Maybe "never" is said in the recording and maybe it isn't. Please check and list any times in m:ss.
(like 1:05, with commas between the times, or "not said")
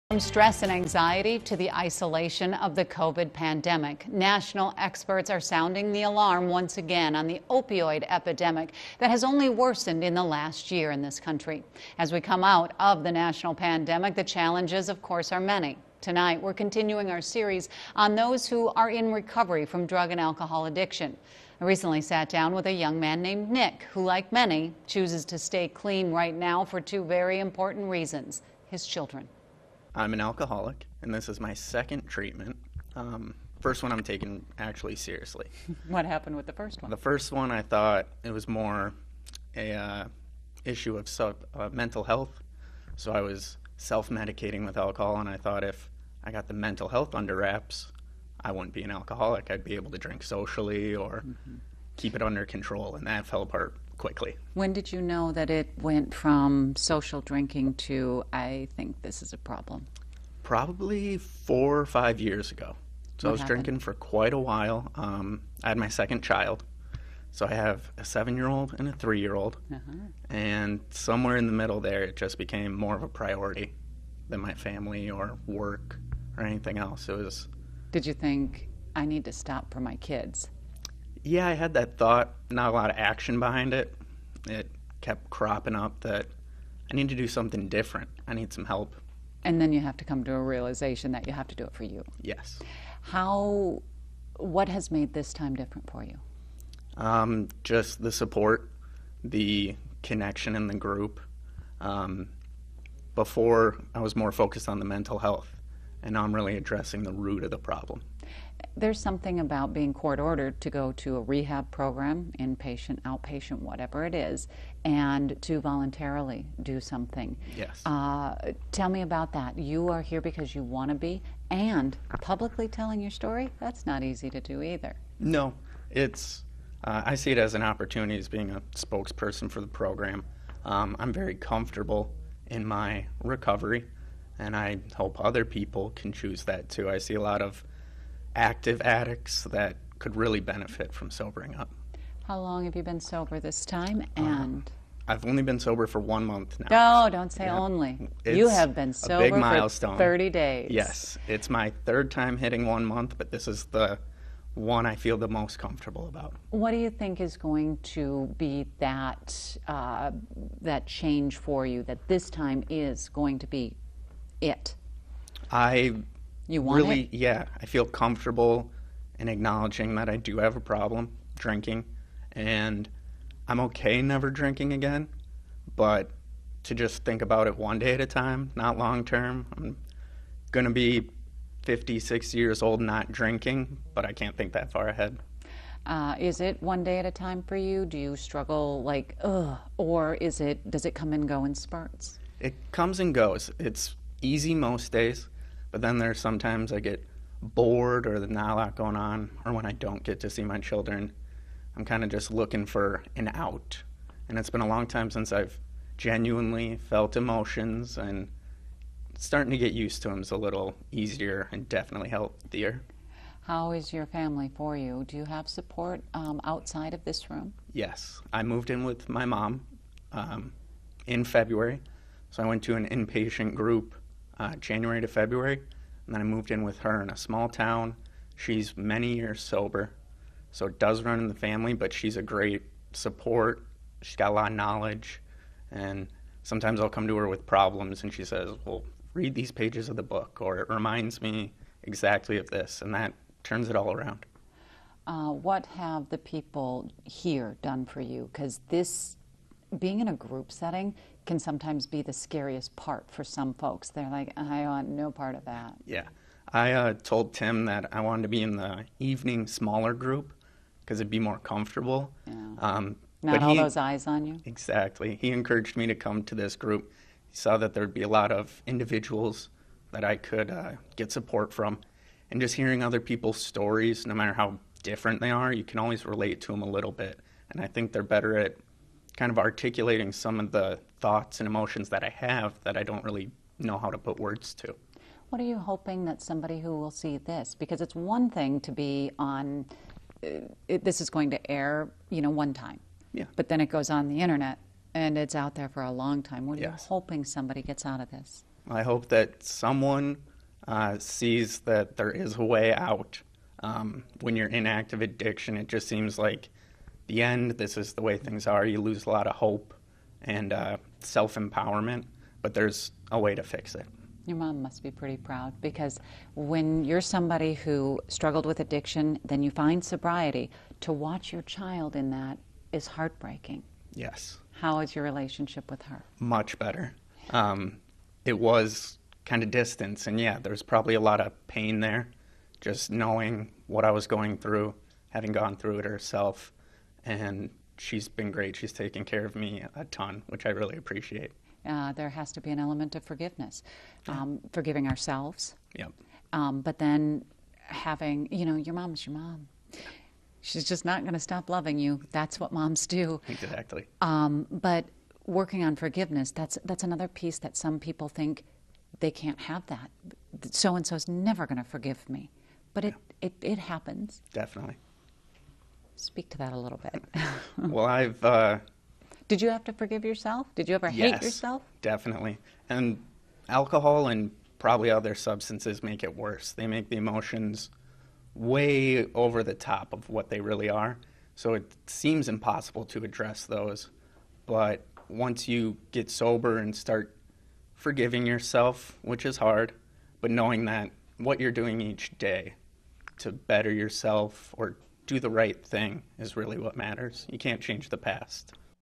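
2:54, 6:01.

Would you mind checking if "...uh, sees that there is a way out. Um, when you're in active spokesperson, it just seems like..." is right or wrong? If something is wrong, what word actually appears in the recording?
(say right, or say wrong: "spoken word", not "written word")
wrong: "addiction", not "spokesperson".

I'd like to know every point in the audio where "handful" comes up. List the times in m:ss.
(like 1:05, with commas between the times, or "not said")
not said.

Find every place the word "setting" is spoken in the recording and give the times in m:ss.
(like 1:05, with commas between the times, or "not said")
4:10.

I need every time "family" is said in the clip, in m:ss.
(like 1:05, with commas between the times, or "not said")
1:14, 3:34, 3:51.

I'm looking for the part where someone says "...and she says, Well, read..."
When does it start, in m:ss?
3:58.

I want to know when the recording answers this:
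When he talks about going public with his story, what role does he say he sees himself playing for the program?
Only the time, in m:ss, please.
2:08.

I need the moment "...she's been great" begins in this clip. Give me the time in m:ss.
5:37.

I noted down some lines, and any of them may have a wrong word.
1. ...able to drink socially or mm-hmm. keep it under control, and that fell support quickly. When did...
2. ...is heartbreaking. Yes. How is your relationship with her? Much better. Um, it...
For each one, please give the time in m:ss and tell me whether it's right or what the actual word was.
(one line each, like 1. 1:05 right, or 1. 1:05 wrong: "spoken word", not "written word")
1. 0:49 wrong: "apart", not "support"
2. 5:22 right.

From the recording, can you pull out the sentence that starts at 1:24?
It kept cropping up that I need to do something different.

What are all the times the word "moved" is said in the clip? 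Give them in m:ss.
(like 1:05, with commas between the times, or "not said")
3:38, 3:46.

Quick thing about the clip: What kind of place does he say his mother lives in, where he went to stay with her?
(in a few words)
small town.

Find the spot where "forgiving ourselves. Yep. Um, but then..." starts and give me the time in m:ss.
5:44.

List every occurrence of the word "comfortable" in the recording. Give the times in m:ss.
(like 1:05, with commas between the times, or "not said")
2:11, 2:35, 2:47, 4:21.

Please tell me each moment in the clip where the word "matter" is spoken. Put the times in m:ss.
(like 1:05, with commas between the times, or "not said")
4:34, 6:36.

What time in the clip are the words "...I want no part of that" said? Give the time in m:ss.
4:14.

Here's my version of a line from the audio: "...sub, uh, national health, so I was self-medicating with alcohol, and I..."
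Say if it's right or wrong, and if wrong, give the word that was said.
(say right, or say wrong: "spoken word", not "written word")
wrong: "mental", not "national".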